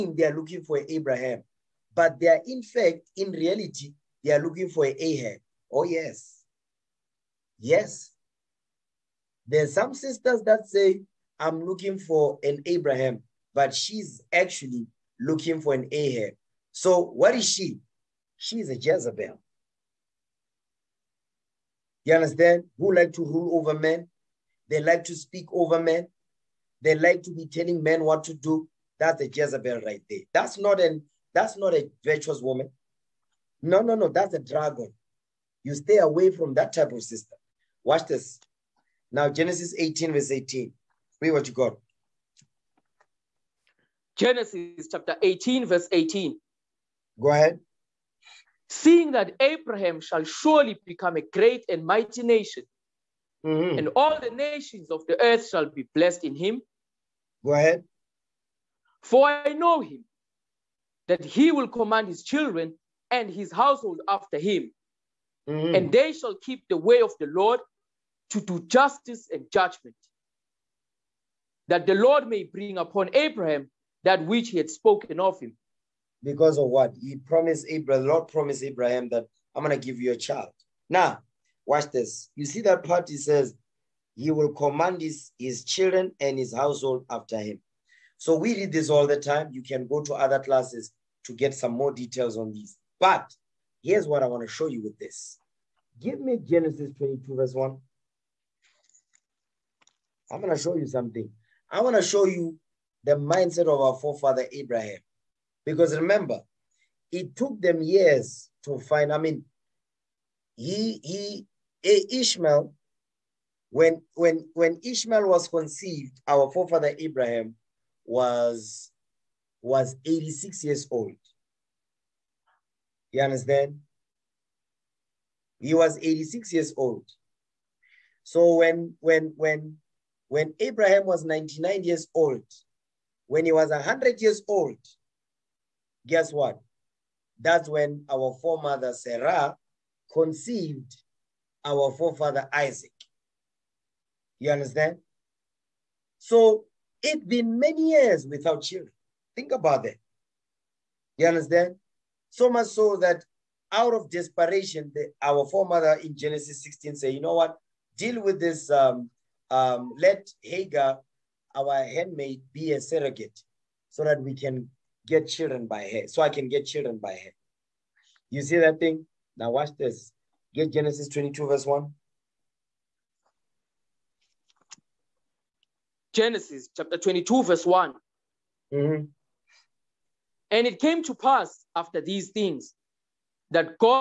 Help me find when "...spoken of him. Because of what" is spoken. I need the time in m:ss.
1:14.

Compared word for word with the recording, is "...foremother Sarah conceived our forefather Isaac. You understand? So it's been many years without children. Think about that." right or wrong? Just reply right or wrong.
right.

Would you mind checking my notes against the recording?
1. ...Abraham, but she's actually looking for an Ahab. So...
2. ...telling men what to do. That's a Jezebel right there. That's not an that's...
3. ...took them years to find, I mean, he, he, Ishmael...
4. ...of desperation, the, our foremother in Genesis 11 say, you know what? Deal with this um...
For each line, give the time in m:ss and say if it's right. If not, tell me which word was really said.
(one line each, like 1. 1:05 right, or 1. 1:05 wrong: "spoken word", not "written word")
1. 0:12 right
2. 0:27 right
3. 1:47 right
4. 2:33 wrong: "16", not "11".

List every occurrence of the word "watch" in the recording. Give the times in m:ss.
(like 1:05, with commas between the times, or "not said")
0:37, 1:21, 2:49.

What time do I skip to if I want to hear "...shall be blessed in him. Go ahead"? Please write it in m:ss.
0:55.